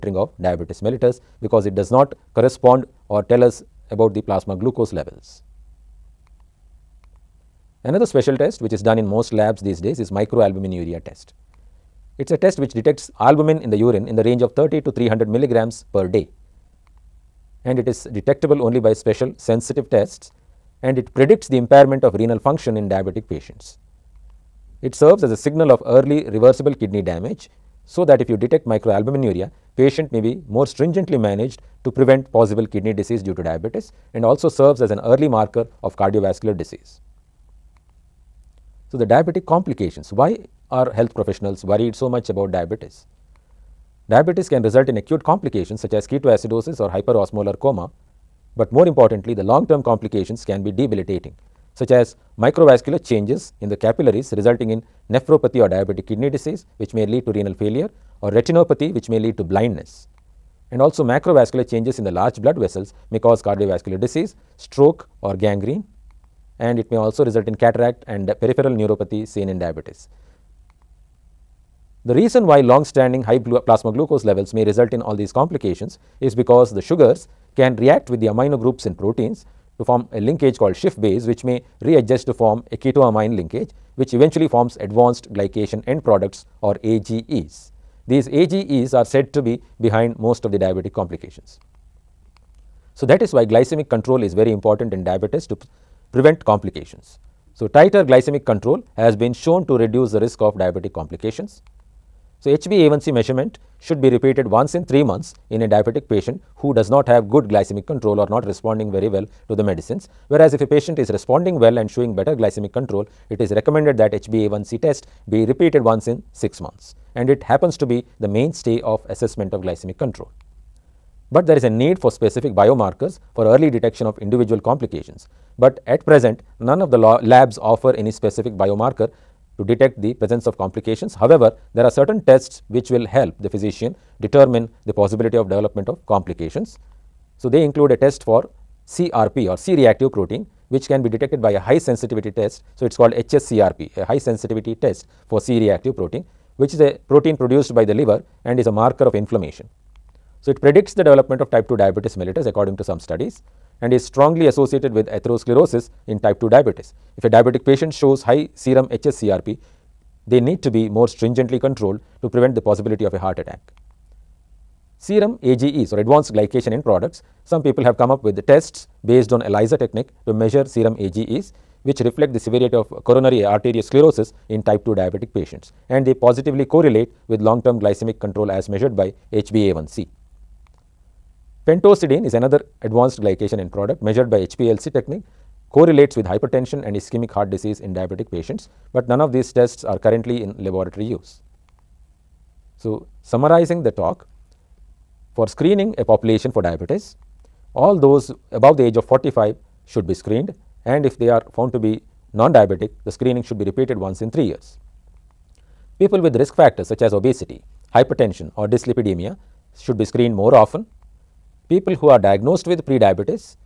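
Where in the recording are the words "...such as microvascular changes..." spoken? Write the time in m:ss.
0:51.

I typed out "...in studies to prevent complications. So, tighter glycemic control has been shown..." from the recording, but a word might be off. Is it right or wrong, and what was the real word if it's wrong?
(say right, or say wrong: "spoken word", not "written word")
wrong: "diabetes", not "studies".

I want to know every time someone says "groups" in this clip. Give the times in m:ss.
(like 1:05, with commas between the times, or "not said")
1:18.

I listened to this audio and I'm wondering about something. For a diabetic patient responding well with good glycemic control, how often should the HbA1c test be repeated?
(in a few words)
once in 6 months.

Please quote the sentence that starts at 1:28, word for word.
These AGEs are said to be behind most of the diabetic complications.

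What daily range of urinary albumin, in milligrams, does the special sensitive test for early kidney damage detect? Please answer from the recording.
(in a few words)
30 to 300.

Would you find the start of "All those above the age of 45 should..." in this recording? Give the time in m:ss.
3:17.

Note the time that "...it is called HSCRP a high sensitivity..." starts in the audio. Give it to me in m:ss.
2:22.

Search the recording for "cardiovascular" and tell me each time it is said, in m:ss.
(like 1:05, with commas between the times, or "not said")
0:35, 1:03.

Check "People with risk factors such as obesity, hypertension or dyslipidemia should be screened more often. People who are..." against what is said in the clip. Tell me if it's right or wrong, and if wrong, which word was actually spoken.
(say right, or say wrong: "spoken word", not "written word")
right.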